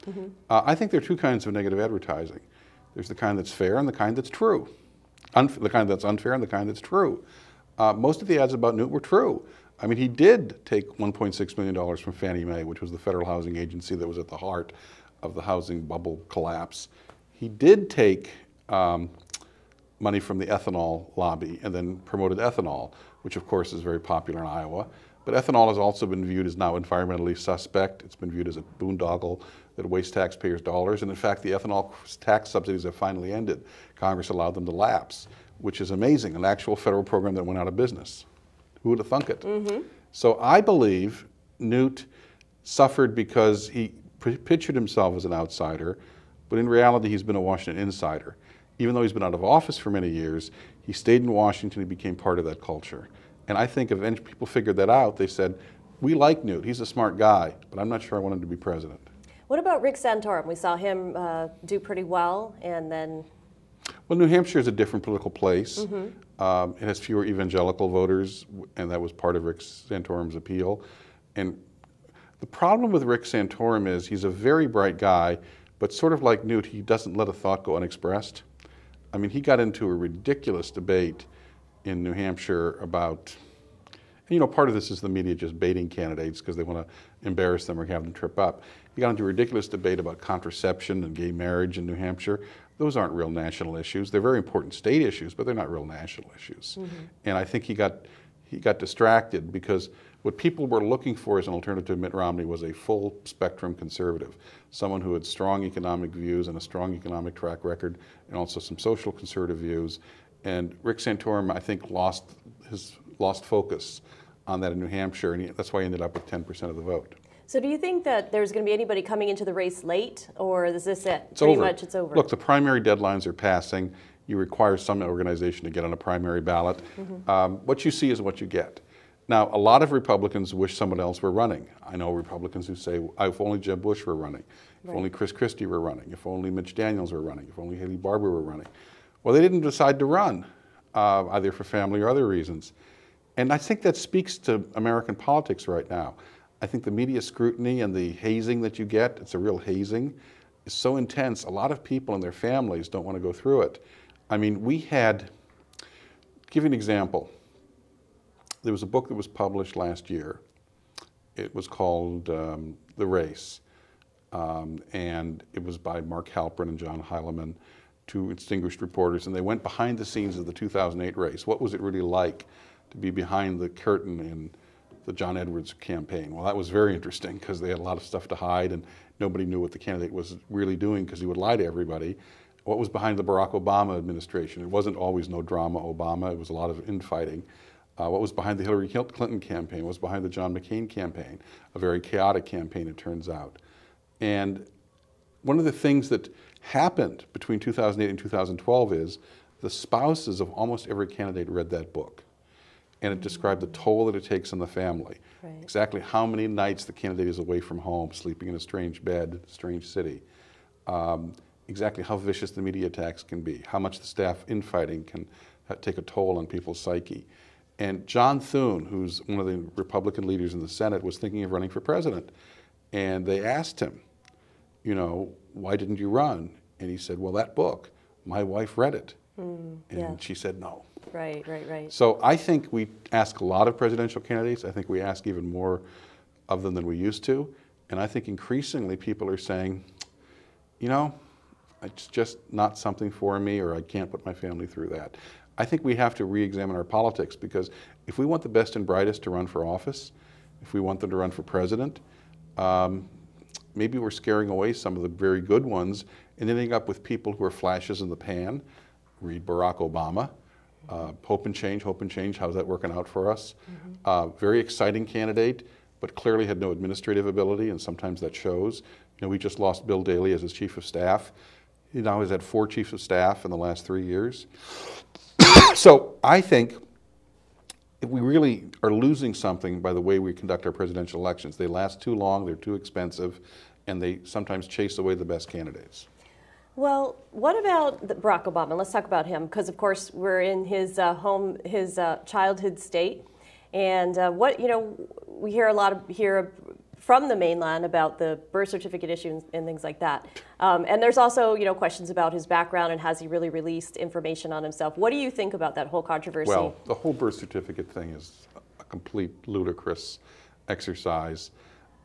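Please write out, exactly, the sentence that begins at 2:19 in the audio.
Well, they didn't decide to run, uh, either for family or other reasons.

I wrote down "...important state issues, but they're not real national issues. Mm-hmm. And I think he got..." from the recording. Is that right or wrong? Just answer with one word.
right.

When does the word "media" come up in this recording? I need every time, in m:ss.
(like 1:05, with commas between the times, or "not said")
1:25, 2:26, 3:32.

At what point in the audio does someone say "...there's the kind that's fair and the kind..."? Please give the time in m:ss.
0:02.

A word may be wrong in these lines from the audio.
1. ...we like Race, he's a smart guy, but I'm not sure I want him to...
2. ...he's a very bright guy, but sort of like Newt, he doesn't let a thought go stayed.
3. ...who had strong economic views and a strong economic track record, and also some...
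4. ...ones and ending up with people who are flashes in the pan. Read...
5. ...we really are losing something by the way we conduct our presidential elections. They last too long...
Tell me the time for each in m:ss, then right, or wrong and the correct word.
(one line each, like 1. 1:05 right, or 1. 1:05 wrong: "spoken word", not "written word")
1. 0:56 wrong: "Newt", not "Race"
2. 1:14 wrong: "unexpressed", not "stayed"
3. 1:45 right
4. 4:15 right
5. 4:38 right.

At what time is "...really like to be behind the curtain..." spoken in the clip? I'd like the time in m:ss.
2:51.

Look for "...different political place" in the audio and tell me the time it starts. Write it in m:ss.
1:04.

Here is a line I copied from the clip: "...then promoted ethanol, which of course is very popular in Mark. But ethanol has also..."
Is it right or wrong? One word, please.
wrong.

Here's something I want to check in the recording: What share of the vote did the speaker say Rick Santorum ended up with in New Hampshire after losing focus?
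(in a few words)
10%.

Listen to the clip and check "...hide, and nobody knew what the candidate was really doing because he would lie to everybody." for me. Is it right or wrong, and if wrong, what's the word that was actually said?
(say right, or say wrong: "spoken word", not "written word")
right.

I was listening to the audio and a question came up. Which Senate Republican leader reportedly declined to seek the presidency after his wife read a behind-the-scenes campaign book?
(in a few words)
John Thune.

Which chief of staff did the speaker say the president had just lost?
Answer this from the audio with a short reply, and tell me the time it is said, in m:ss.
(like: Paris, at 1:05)
Bill Daley, at 4:29.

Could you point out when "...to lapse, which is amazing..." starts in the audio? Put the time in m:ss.
0:34.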